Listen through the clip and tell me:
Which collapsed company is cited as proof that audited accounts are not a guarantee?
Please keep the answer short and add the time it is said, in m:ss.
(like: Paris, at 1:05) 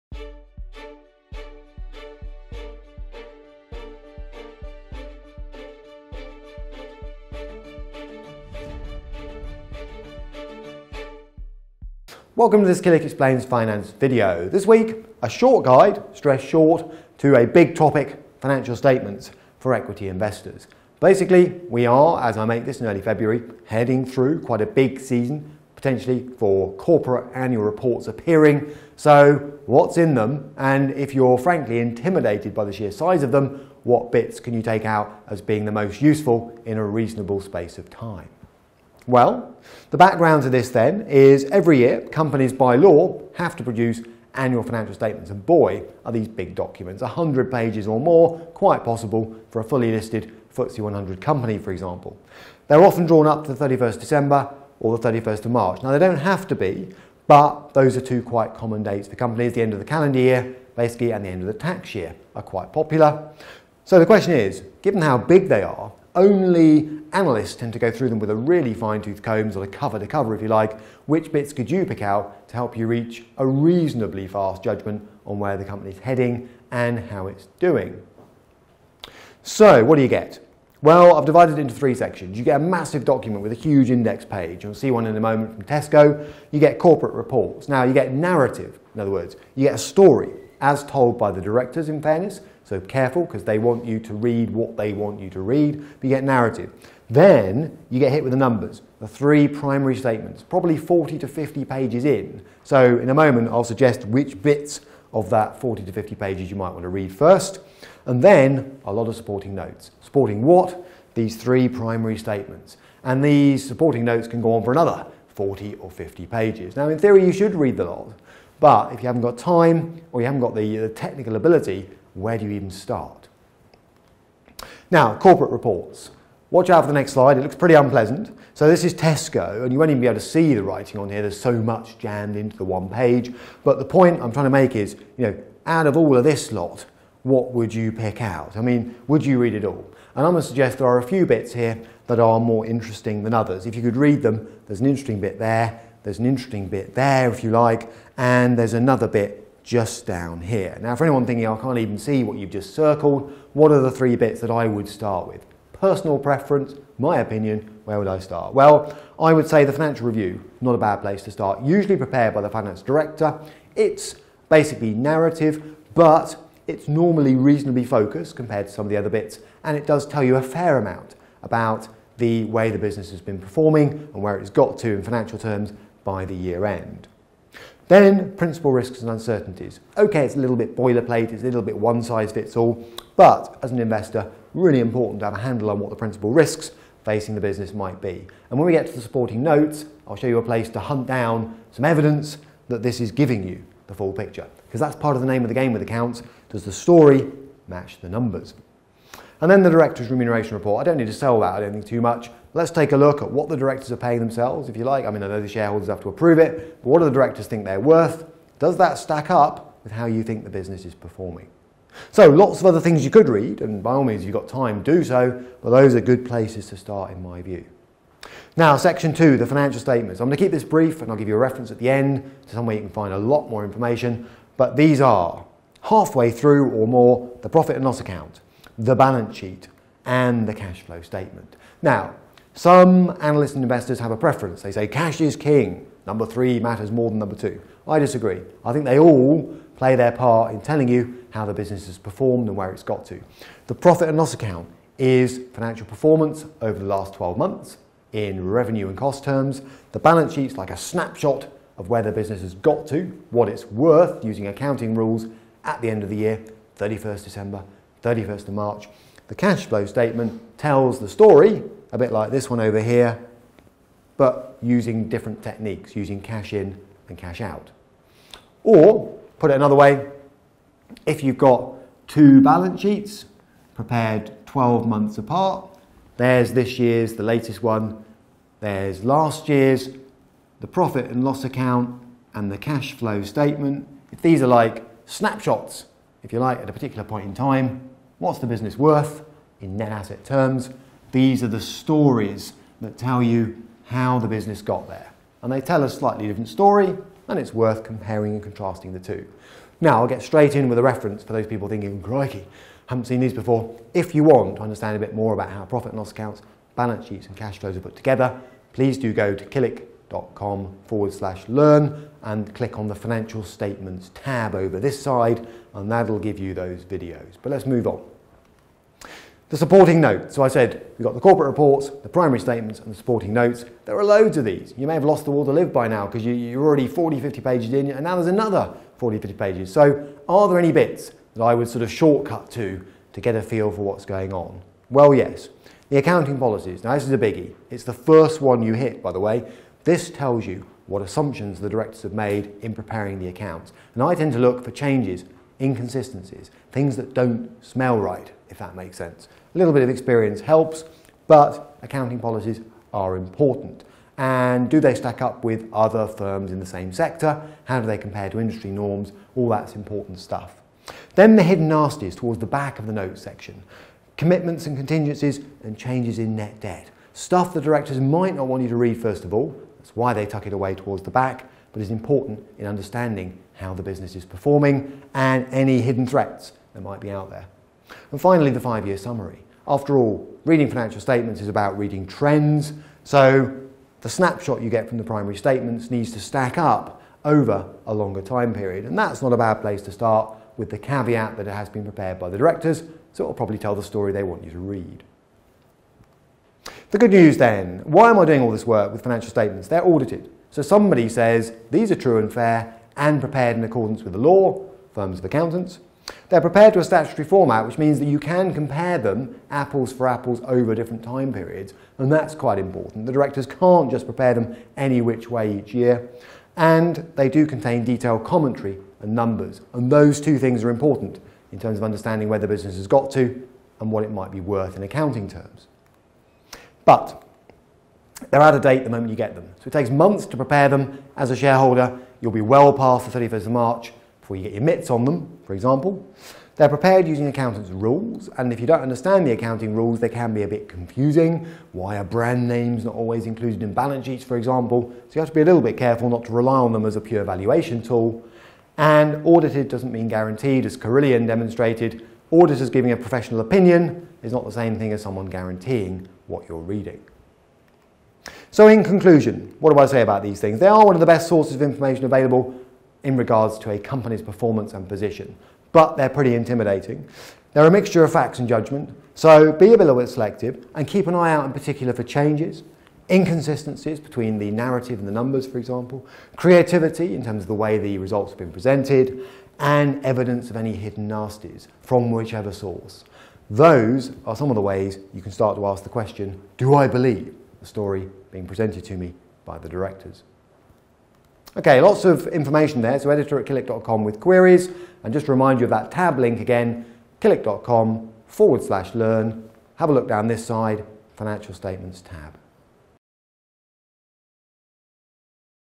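Carillion, at 7:30.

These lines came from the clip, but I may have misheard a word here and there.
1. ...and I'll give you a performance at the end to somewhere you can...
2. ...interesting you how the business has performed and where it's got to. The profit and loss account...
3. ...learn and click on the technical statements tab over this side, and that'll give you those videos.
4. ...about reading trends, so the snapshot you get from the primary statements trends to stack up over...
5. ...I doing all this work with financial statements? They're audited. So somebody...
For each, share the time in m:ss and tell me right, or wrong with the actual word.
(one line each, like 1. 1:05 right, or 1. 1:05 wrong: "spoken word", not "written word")
1. 3:41 wrong: "reference", not "performance"
2. 4:00 wrong: "telling", not "interesting"
3. 5:11 wrong: "financial", not "technical"
4. 6:21 wrong: "needs", not "trends"
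5. 6:38 right.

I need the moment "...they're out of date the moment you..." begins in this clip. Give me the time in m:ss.
7:08.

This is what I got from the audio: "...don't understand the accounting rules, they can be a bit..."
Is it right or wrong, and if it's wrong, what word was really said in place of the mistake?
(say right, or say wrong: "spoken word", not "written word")
right.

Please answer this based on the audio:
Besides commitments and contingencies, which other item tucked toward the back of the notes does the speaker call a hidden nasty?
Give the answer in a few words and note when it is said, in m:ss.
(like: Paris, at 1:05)
Changes in net debt, at 6:05.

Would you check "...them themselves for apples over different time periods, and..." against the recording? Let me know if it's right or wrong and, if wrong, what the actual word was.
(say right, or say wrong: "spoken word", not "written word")
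wrong: "apples", not "themselves".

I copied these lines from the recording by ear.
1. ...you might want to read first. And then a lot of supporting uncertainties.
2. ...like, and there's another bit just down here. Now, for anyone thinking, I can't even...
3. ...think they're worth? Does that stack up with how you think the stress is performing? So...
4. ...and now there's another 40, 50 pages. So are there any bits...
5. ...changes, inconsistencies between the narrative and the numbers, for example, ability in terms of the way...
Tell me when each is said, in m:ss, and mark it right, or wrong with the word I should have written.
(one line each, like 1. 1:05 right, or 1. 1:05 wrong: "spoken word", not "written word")
1. 1:46 wrong: "notes", not "uncertainties"
2. 2:27 right
3. 3:27 wrong: "business", not "stress"
4. 5:27 right
5. 7:52 wrong: "creativity", not "ability".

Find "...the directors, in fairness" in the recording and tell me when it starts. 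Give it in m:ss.
1:31.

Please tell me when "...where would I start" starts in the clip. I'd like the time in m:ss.
2:37.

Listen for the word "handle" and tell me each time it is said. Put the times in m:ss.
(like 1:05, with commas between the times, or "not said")
3:05.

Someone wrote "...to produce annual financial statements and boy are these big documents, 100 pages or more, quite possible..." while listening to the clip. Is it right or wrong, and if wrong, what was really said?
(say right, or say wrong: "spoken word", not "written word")
right.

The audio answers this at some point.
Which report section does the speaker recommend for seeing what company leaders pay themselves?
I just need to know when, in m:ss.
3:19.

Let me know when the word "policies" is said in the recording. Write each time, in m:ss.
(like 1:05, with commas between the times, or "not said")
5:36, 5:52.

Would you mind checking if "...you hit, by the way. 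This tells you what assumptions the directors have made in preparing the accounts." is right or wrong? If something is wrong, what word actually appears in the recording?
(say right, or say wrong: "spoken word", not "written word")
right.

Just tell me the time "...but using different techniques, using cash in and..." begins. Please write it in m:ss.
4:24.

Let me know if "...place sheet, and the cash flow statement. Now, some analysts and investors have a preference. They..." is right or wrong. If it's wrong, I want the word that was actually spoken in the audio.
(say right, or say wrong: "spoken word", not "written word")
wrong: "balance", not "place".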